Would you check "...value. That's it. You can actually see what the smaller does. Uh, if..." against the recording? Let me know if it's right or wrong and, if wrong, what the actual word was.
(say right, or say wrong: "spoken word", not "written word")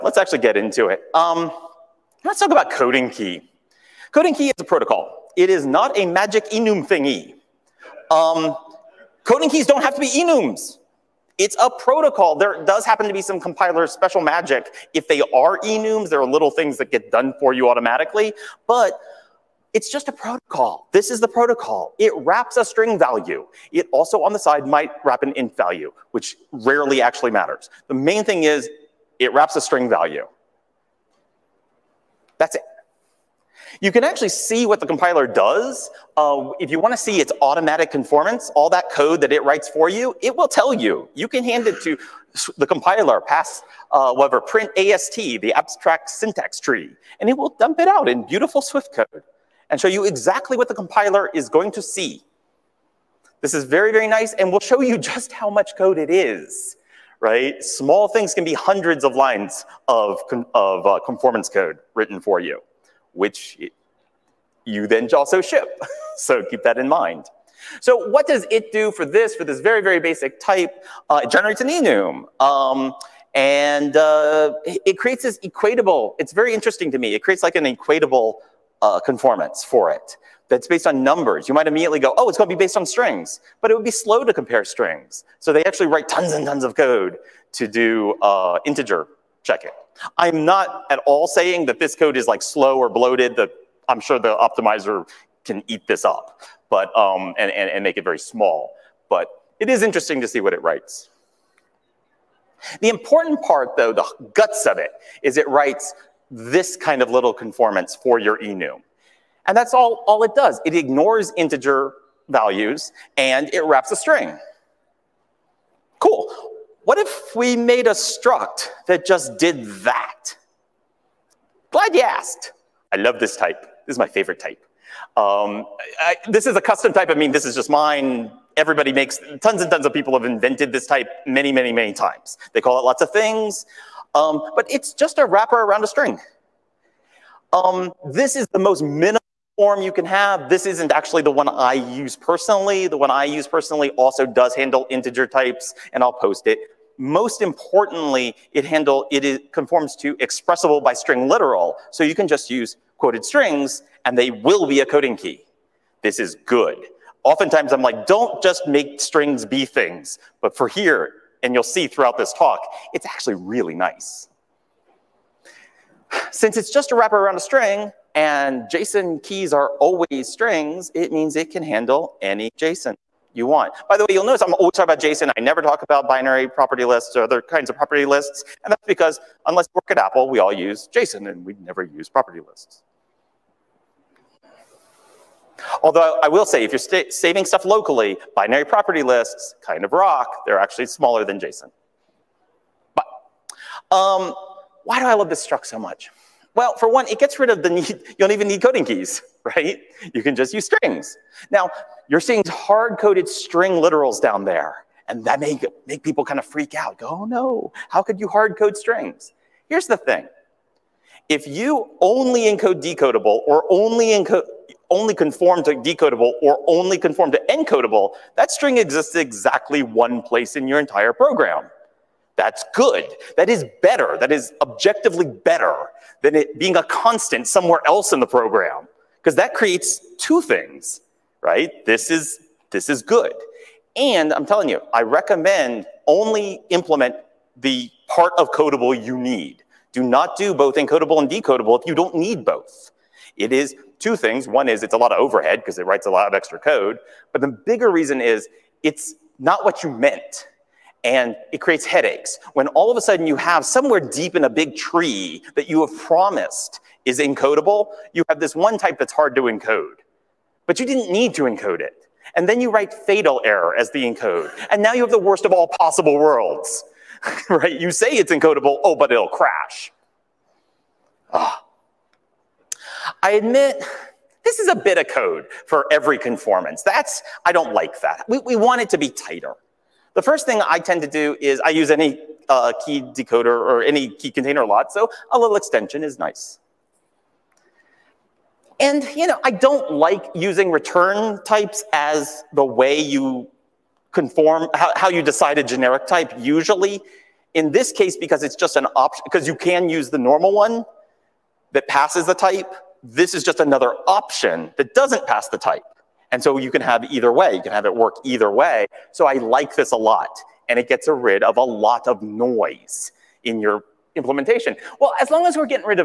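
wrong: "compiler", not "smaller".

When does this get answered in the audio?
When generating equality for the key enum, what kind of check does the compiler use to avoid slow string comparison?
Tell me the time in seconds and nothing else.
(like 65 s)
88 s.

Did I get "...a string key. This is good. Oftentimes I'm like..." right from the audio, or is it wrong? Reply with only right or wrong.
wrong.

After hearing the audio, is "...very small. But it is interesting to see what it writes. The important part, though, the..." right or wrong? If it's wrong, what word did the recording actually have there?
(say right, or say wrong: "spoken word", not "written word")
right.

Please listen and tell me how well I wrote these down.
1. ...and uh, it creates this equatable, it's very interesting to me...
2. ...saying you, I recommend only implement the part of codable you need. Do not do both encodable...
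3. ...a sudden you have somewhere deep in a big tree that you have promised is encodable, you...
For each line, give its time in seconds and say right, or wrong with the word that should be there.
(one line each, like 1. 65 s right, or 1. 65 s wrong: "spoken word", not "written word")
1. 73 s right
2. 234 s wrong: "telling", not "saying"
3. 252 s right.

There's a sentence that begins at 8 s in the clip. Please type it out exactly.
Um, coding keys don't have to be enums.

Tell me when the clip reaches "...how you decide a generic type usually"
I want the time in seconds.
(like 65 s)
294 s.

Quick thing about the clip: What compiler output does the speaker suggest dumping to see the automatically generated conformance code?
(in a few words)
abstract syntax tree.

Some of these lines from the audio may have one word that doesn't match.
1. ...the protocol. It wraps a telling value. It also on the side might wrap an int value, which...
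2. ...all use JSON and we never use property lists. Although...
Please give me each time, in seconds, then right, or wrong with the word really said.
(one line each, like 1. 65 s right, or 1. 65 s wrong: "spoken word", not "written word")
1. 21 s wrong: "string", not "telling"
2. 180 s right.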